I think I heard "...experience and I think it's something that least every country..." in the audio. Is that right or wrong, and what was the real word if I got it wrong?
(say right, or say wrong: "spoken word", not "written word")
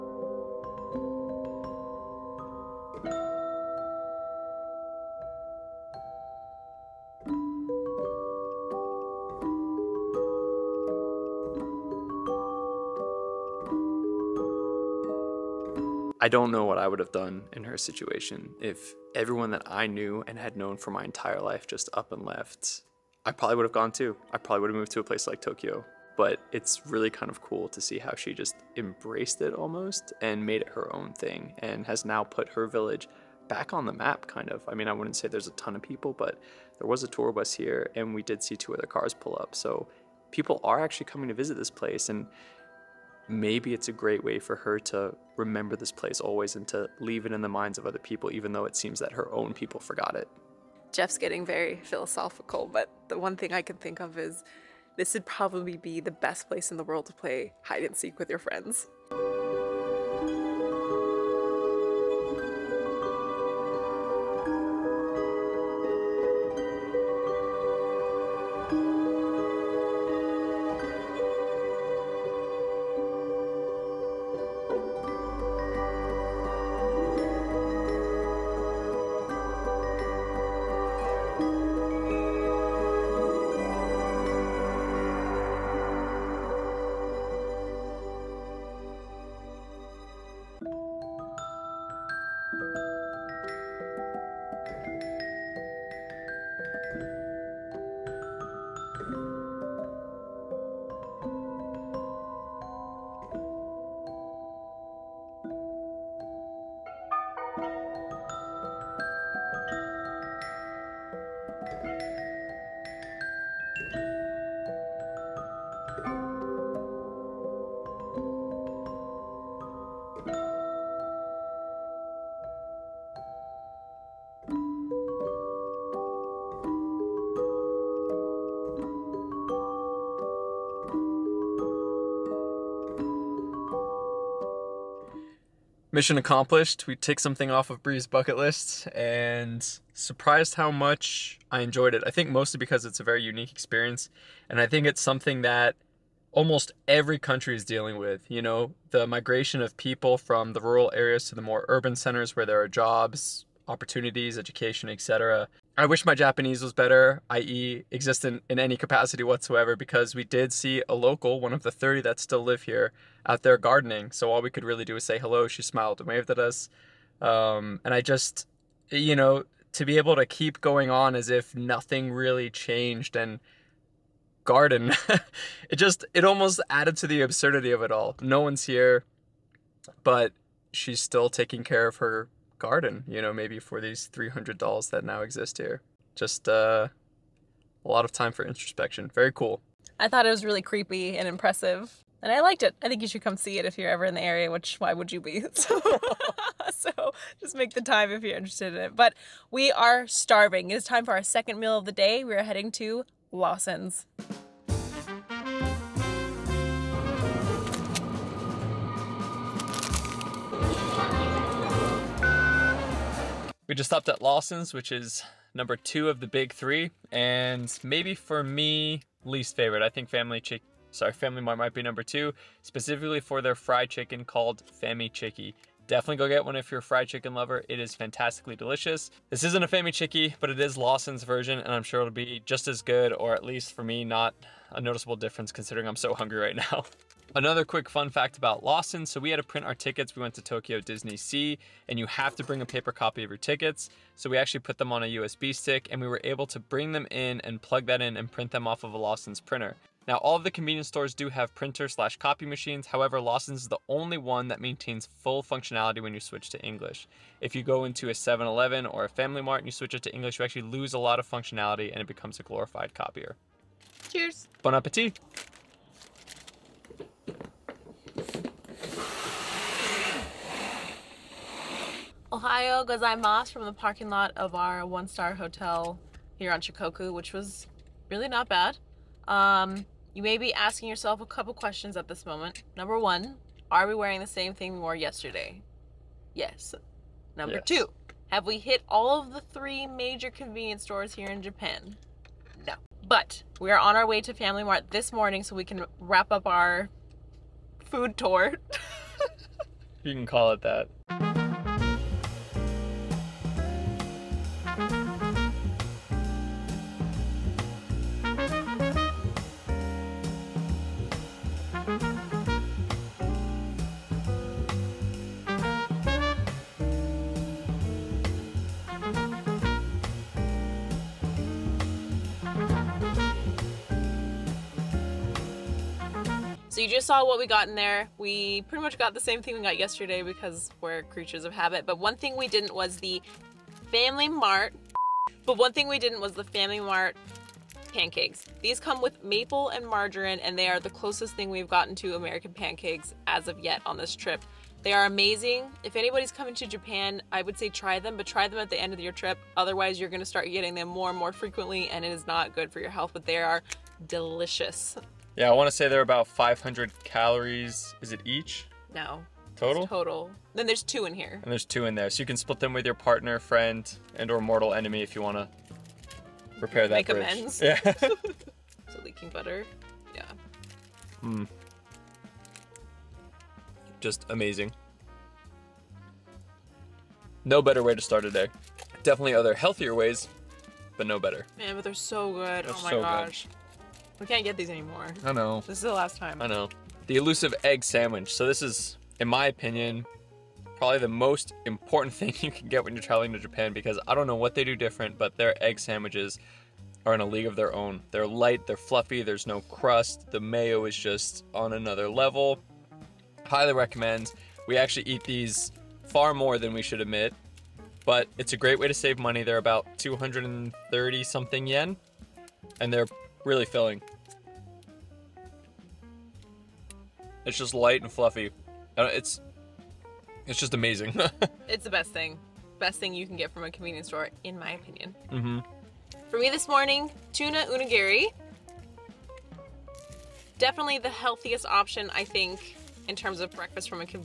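wrong: "almost", not "least".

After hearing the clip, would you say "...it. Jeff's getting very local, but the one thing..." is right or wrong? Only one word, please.
wrong.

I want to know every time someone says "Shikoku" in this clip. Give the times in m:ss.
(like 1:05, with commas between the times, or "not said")
4:36.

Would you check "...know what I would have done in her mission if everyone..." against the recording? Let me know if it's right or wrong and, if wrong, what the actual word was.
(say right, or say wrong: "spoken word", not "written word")
wrong: "situation", not "mission".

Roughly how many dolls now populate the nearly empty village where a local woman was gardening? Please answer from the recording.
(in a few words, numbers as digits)
300.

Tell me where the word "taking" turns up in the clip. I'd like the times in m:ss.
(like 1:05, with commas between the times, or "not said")
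3:01.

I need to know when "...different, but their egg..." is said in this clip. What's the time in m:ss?
6:34.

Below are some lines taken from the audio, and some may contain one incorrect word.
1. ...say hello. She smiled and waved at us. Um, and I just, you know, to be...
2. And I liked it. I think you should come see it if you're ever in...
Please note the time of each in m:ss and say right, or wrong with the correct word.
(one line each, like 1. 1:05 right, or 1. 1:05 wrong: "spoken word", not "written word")
1. 2:45 right
2. 3:12 right.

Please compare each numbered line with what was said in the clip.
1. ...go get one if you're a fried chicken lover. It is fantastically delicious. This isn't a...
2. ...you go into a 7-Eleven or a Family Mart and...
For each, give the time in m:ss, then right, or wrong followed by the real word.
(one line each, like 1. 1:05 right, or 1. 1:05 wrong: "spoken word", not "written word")
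1. 3:46 right
2. 4:17 right.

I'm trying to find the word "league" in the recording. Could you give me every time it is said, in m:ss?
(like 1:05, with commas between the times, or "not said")
6:37.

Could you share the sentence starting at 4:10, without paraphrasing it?
Now all of the convenience stores do have printer slash copy machines.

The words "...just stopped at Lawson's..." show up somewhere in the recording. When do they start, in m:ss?
3:33.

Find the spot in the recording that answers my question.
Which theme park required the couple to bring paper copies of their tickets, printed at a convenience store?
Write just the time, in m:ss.
4:00.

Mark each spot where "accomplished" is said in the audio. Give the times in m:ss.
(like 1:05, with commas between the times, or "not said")
2:16.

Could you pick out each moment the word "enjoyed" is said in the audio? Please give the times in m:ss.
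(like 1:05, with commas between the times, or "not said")
2:21.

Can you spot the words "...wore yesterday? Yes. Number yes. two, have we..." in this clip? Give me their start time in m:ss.
4:44.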